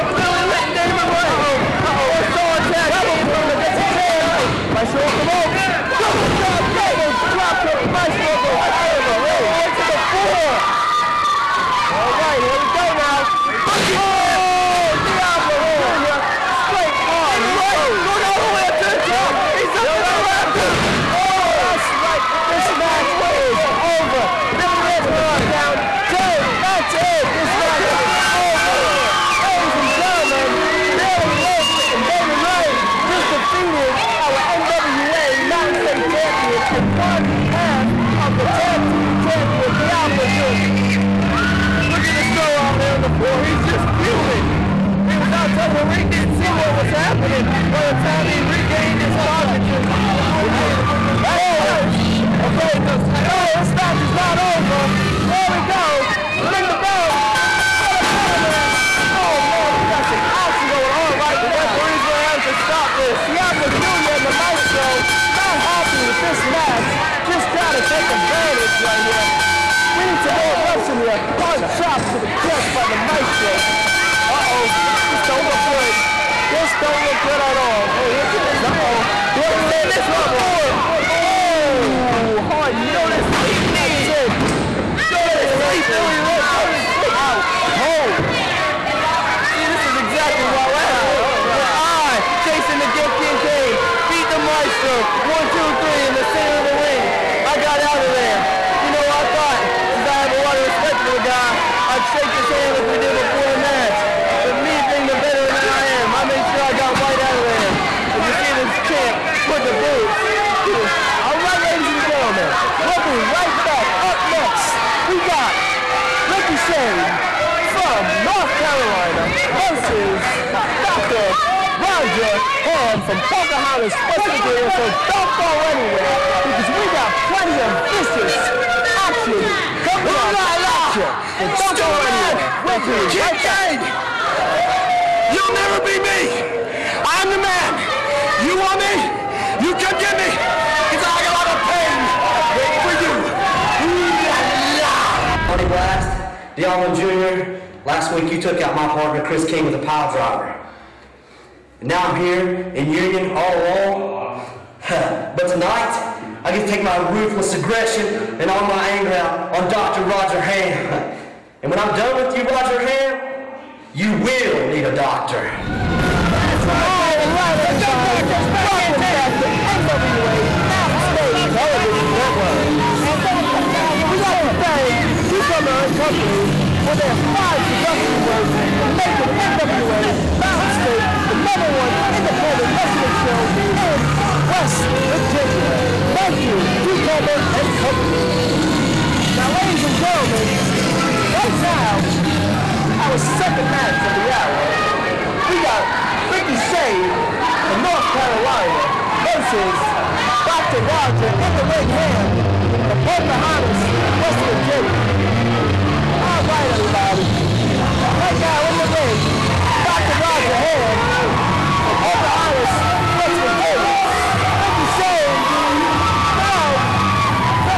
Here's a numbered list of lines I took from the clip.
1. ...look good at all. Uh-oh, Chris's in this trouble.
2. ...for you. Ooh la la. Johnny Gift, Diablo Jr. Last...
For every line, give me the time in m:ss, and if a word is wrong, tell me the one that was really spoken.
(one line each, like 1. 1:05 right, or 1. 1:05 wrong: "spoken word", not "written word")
1. 1:17 wrong: "Bill", not "Chris"
2. 2:22 wrong: "Blast", not "Gift".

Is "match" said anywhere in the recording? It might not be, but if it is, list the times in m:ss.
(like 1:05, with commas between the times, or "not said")
0:22, 0:27, 0:53, 1:06, 1:43, 3:13.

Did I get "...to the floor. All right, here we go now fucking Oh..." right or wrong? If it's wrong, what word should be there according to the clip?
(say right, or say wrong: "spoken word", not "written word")
right.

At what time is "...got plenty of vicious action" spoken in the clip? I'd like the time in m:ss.
2:06.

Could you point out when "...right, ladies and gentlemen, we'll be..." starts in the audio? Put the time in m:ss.
1:51.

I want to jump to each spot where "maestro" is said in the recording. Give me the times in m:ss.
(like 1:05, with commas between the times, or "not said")
0:07, 1:04, 1:13, 1:34.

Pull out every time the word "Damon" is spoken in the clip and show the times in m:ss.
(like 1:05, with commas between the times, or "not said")
0:00, 0:32.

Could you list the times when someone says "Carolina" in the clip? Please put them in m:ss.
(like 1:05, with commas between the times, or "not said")
1:58, 3:18.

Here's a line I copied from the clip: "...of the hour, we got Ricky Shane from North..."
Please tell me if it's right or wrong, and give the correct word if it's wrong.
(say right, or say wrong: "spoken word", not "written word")
right.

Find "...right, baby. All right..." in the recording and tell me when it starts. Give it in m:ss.
2:46.